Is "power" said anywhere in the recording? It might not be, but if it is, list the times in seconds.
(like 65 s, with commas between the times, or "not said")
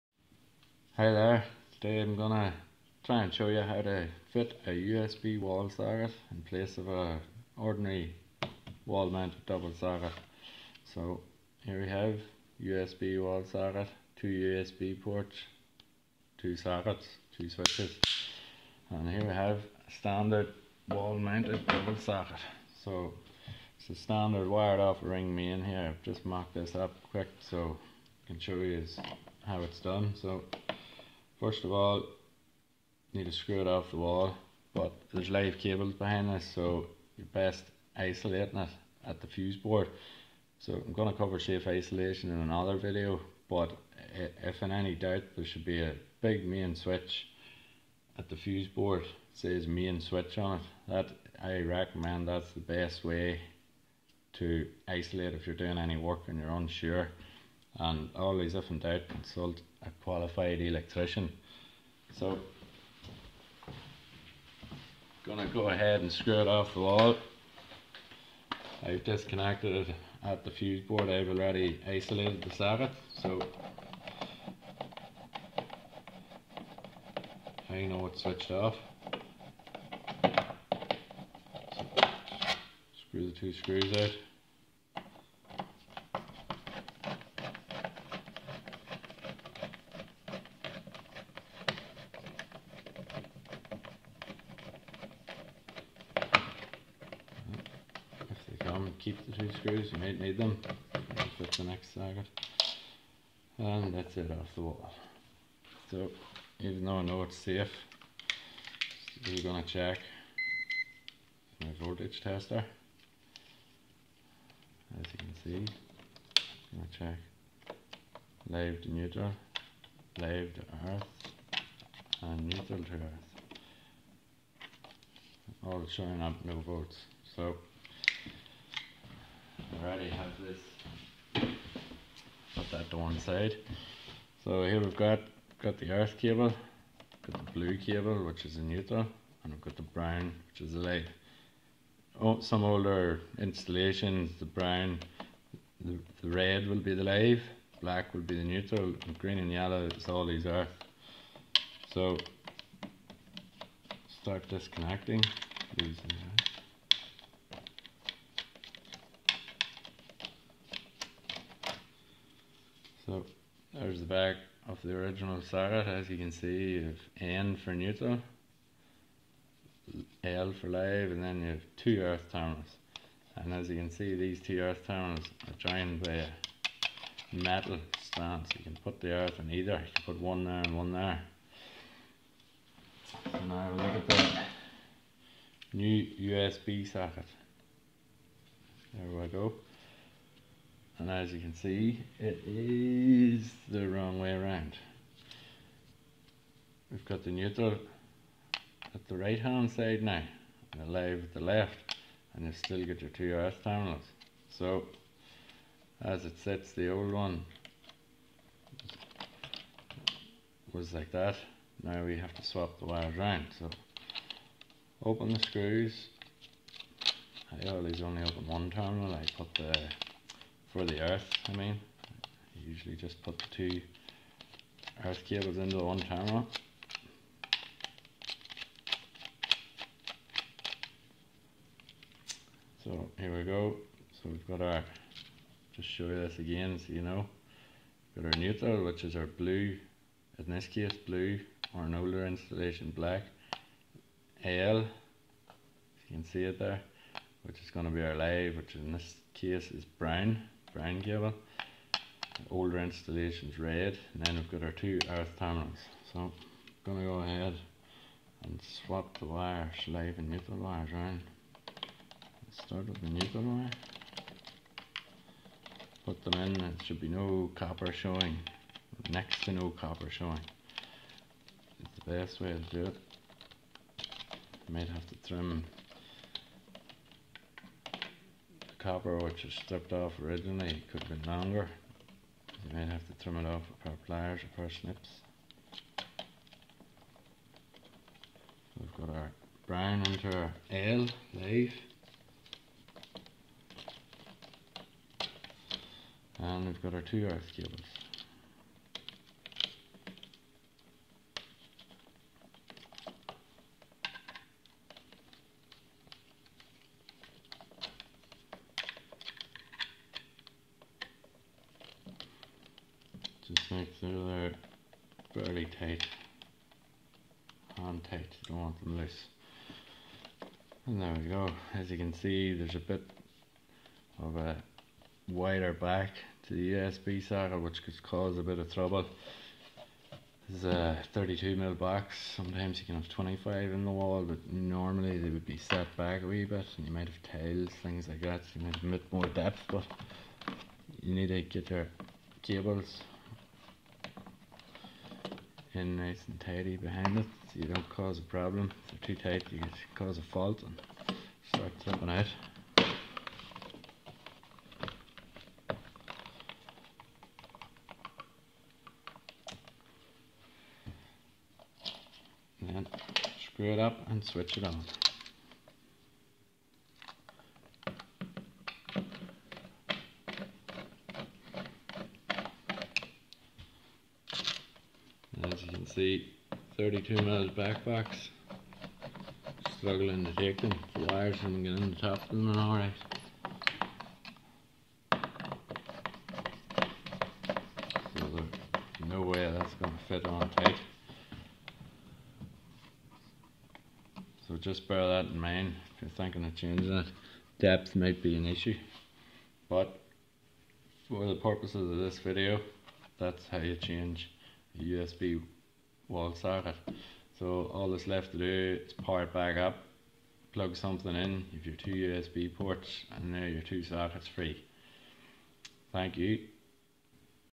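408 s.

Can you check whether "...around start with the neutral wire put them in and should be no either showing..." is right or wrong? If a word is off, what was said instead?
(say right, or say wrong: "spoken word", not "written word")
wrong: "copper", not "either".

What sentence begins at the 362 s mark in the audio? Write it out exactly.
then screw it up and switch it on.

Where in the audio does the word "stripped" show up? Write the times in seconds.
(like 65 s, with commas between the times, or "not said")
279 s.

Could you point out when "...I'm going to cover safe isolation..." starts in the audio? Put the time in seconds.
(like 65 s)
40 s.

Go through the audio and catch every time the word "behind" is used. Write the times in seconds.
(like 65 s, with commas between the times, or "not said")
35 s, 346 s.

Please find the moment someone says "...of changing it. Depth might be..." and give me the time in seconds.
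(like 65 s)
396 s.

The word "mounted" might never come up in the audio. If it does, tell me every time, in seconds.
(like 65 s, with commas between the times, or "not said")
9 s, 21 s.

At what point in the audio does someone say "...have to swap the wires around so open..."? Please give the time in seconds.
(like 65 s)
212 s.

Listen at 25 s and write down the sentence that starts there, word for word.
I've just mocked this up quick so I can show you how it's done.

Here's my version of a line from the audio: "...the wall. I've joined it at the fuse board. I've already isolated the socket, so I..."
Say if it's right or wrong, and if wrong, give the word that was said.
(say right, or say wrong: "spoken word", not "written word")
wrong: "disconnected", not "joined".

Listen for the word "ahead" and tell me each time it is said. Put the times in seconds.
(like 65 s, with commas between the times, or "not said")
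65 s, 257 s.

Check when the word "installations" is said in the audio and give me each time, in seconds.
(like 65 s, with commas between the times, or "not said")
143 s, 242 s, 252 s.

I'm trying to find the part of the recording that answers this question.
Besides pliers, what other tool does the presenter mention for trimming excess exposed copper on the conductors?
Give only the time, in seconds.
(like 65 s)
284 s.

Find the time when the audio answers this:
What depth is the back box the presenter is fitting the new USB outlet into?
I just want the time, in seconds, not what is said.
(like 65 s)
331 s.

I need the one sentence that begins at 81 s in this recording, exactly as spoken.
So screw the two screws out.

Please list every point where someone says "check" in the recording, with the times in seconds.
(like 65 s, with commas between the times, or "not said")
109 s, 116 s.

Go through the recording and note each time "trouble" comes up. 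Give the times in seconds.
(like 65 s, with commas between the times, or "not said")
328 s.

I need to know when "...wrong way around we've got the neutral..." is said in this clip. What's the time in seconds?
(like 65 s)
193 s.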